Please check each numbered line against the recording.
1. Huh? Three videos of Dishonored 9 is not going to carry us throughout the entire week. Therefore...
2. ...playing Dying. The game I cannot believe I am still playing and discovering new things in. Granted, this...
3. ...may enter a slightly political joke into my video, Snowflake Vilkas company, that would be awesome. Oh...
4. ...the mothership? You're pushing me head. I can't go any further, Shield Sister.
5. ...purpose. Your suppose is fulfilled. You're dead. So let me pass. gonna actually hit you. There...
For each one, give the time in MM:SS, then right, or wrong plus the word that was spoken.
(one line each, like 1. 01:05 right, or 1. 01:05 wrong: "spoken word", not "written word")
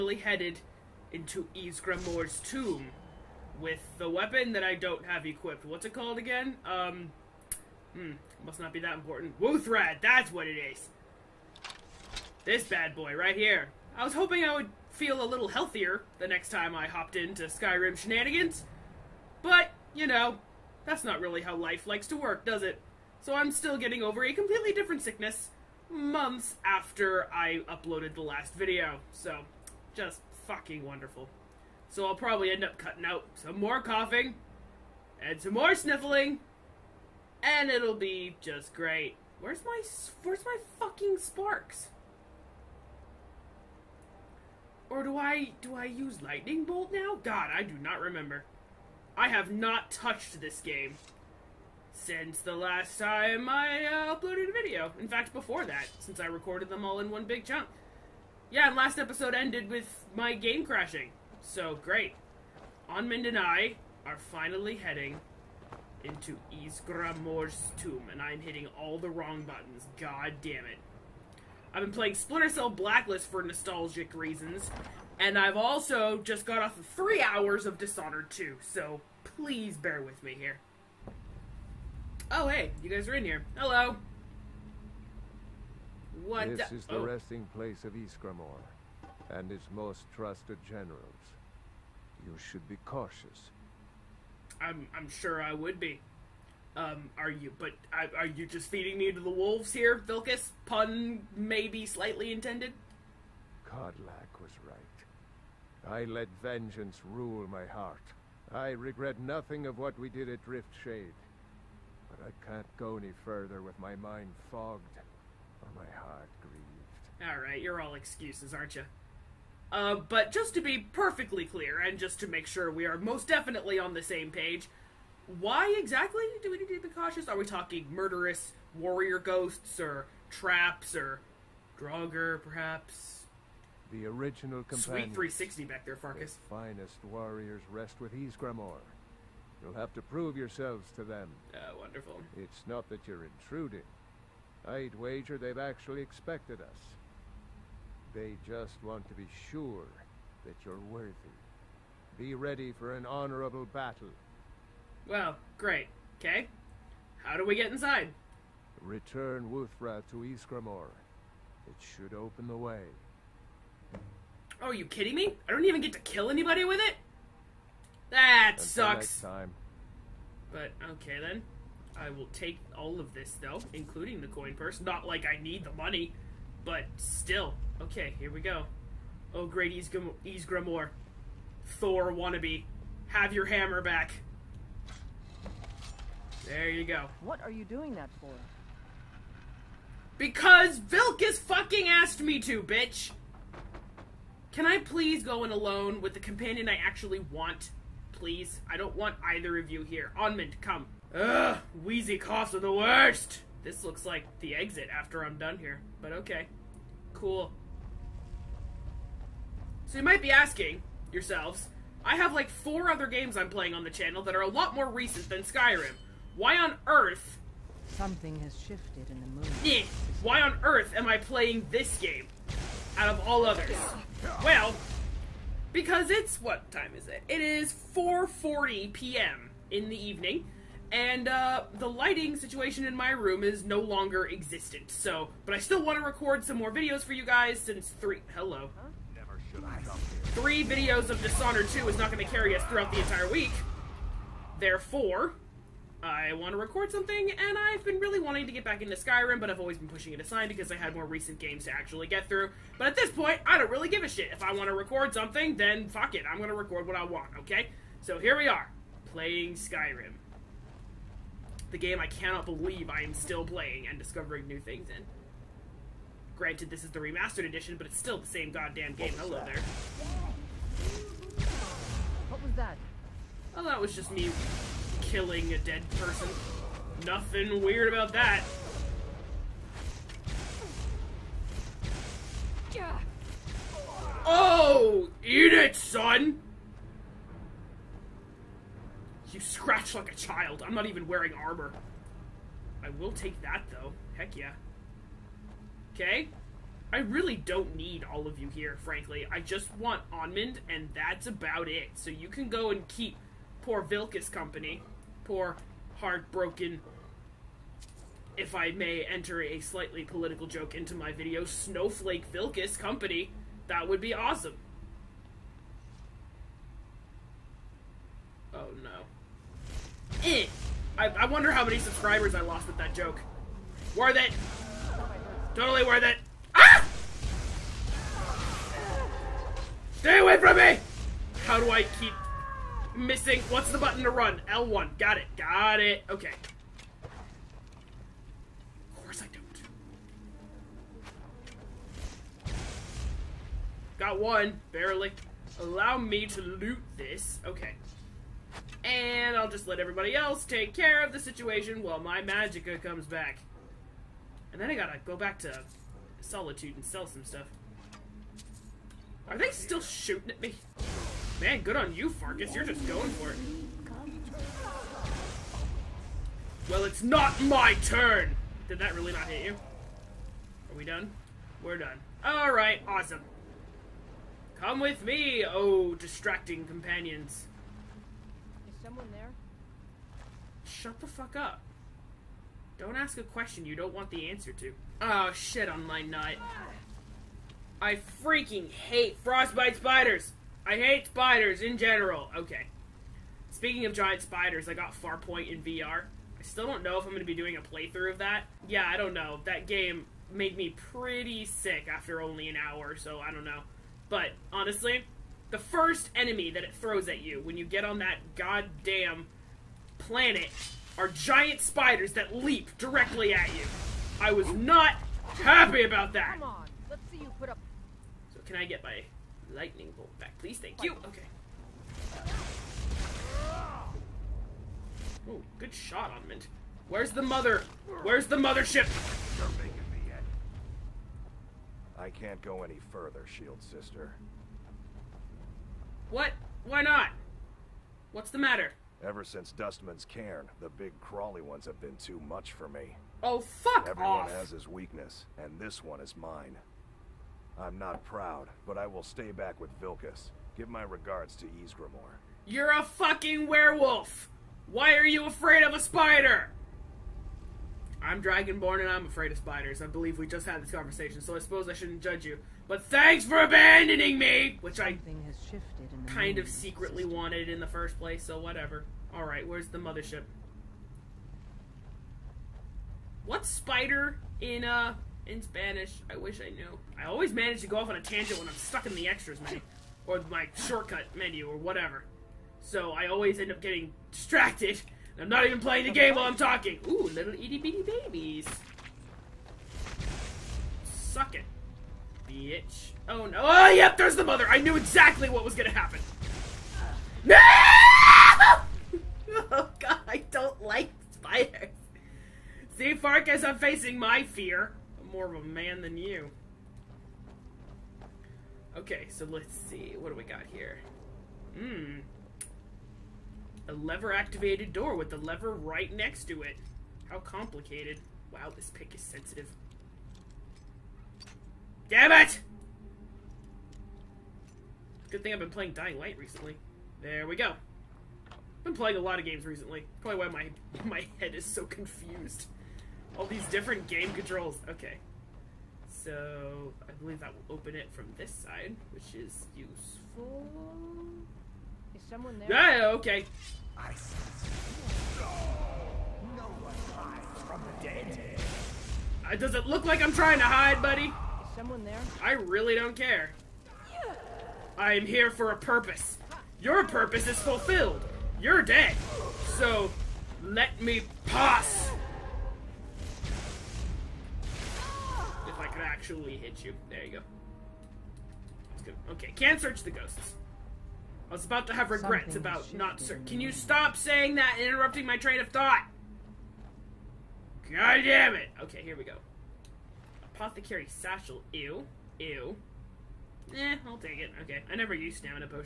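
1. 03:58 wrong: "2", not "9"
2. 04:19 wrong: "Skyrim", not "Dying"
3. 05:08 right
4. 07:08 wrong: "making", not "pushing"
5. 09:15 wrong: "purpose", not "suppose".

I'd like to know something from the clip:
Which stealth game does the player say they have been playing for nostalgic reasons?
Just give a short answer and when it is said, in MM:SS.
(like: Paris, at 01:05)
Splinter Cell Blacklist, at 01:12.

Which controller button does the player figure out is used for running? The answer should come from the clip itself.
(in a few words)
L1.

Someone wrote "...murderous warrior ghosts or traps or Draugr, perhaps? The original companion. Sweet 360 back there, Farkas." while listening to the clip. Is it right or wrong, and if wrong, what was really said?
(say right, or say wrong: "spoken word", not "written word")
right.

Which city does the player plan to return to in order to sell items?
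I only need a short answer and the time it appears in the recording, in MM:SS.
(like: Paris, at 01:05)
Solitude, at 05:56.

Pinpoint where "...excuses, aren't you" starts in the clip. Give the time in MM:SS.
01:57.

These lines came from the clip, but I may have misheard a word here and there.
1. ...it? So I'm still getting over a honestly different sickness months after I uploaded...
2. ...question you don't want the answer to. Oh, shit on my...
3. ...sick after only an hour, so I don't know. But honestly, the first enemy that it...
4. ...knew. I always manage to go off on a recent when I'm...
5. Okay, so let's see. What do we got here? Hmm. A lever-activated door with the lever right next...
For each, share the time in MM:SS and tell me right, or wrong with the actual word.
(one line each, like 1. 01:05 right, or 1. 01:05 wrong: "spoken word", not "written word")
1. 00:22 wrong: "completely", not "honestly"
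2. 06:23 right
3. 06:41 right
4. 07:56 wrong: "tangent", not "recent"
5. 08:28 right.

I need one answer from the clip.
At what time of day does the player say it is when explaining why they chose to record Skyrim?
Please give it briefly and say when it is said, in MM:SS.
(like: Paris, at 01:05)
4:40 p.m., at 03:47.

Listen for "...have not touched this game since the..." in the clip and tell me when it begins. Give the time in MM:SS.
00:49.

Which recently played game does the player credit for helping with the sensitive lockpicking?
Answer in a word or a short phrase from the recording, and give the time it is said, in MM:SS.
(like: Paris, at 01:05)
Dying Light, at 08:45.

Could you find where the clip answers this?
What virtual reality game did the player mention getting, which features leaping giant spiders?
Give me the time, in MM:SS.
06:35.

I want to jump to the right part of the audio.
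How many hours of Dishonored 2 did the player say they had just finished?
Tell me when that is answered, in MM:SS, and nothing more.
01:16.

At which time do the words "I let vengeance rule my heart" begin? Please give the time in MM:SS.
01:45.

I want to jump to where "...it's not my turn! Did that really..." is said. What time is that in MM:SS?
06:06.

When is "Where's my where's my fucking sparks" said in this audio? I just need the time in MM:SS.
00:39.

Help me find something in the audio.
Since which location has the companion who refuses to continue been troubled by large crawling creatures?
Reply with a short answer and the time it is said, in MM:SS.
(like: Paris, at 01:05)
Dustman's Cairn, at 07:19.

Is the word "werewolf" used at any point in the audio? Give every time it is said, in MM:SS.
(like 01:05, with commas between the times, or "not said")
07:33.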